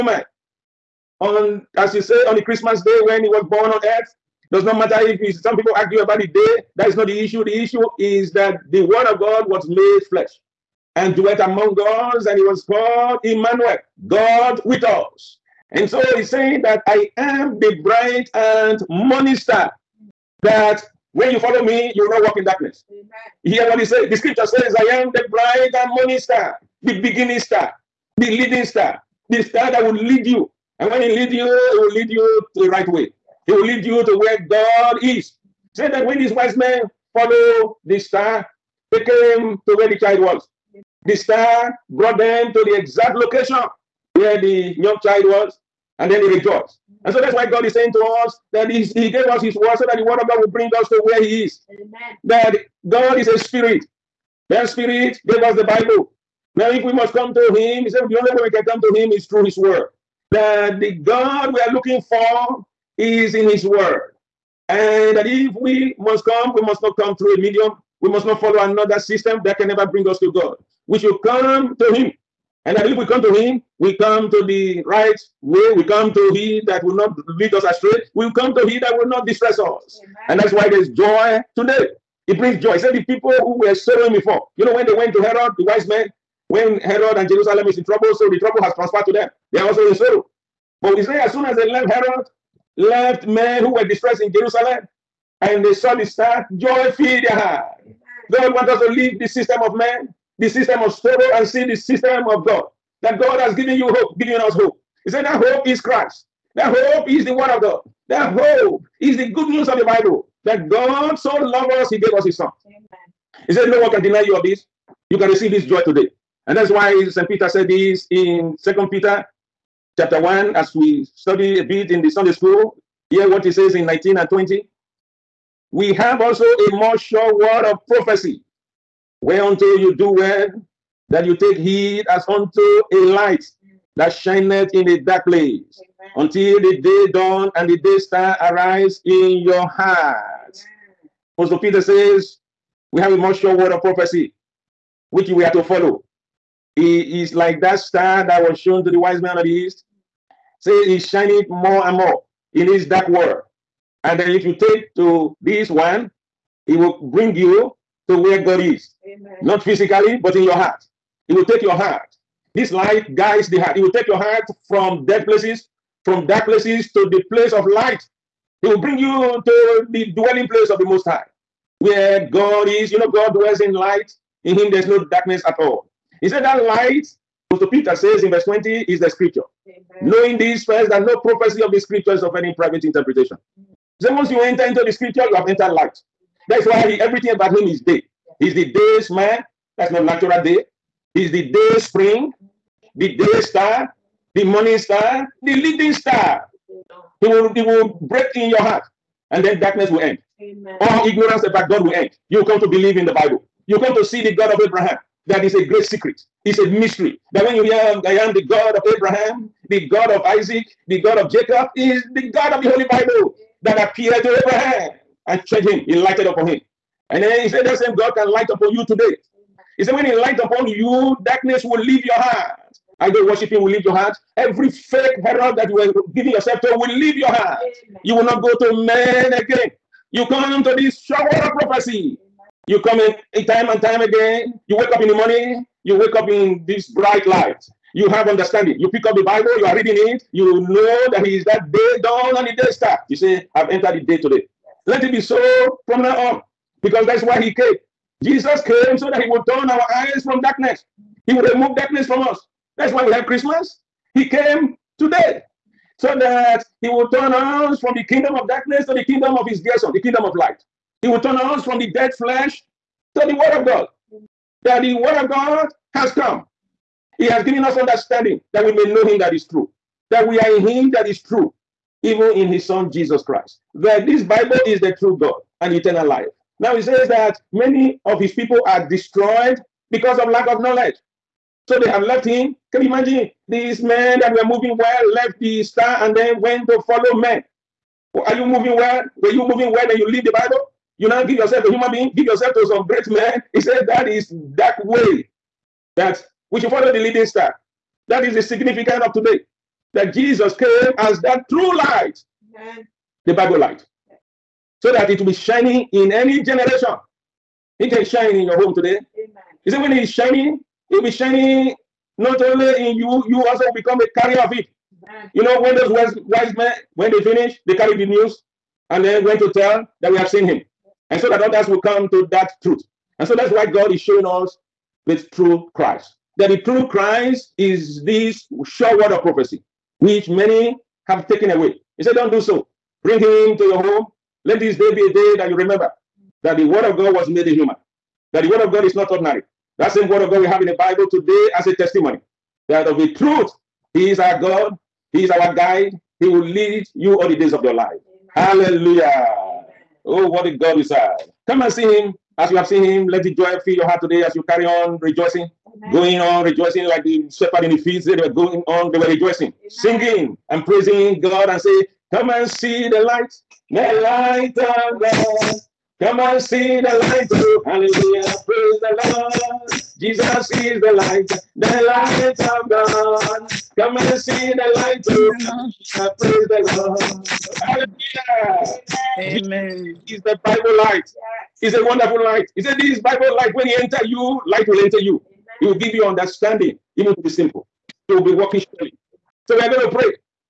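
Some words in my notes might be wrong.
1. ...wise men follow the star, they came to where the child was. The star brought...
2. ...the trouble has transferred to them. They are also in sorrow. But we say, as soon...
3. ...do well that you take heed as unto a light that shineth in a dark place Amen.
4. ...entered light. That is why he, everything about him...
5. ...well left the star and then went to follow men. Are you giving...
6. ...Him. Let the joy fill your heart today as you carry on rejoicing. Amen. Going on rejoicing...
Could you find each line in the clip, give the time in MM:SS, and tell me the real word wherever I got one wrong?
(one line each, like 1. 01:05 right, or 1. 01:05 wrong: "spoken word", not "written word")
1. 00:36 right
2. 01:28 right
3. 02:09 right
4. 03:05 right
5. 04:44 wrong: "moving", not "giving"
6. 05:52 right.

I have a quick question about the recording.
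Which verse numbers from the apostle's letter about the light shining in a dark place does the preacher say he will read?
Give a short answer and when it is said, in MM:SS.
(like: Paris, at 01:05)
19 and 20, at 02:03.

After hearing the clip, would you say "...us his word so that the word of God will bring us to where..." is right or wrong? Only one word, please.
right.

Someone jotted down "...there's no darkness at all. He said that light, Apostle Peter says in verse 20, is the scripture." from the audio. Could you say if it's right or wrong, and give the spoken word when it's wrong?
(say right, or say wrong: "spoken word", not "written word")
right.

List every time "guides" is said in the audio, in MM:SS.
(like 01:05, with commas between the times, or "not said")
02:43, 05:45.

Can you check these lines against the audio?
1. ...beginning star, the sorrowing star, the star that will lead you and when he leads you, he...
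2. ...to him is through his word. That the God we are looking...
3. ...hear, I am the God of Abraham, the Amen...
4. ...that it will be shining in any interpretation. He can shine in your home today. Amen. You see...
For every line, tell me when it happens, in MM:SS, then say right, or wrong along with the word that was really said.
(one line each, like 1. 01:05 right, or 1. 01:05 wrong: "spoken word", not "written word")
1. 00:26 wrong: "leading", not "sorrowing"
2. 00:58 right
3. 03:27 wrong: "God", not "Amen"
4. 05:04 wrong: "generation", not "interpretation".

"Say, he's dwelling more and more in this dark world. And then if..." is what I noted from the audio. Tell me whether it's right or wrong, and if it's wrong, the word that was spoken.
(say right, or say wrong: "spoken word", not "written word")
wrong: "shining", not "dwelling".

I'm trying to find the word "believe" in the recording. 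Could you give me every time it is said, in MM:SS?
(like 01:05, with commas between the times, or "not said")
01:12, 03:22.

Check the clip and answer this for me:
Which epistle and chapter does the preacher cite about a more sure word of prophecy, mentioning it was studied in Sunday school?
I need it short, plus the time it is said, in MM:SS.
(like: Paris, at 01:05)
Second Peter chapter 1, at 01:58.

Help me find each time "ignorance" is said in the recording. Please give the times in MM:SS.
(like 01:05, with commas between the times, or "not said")
03:21.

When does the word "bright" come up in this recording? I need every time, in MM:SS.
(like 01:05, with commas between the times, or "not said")
03:56.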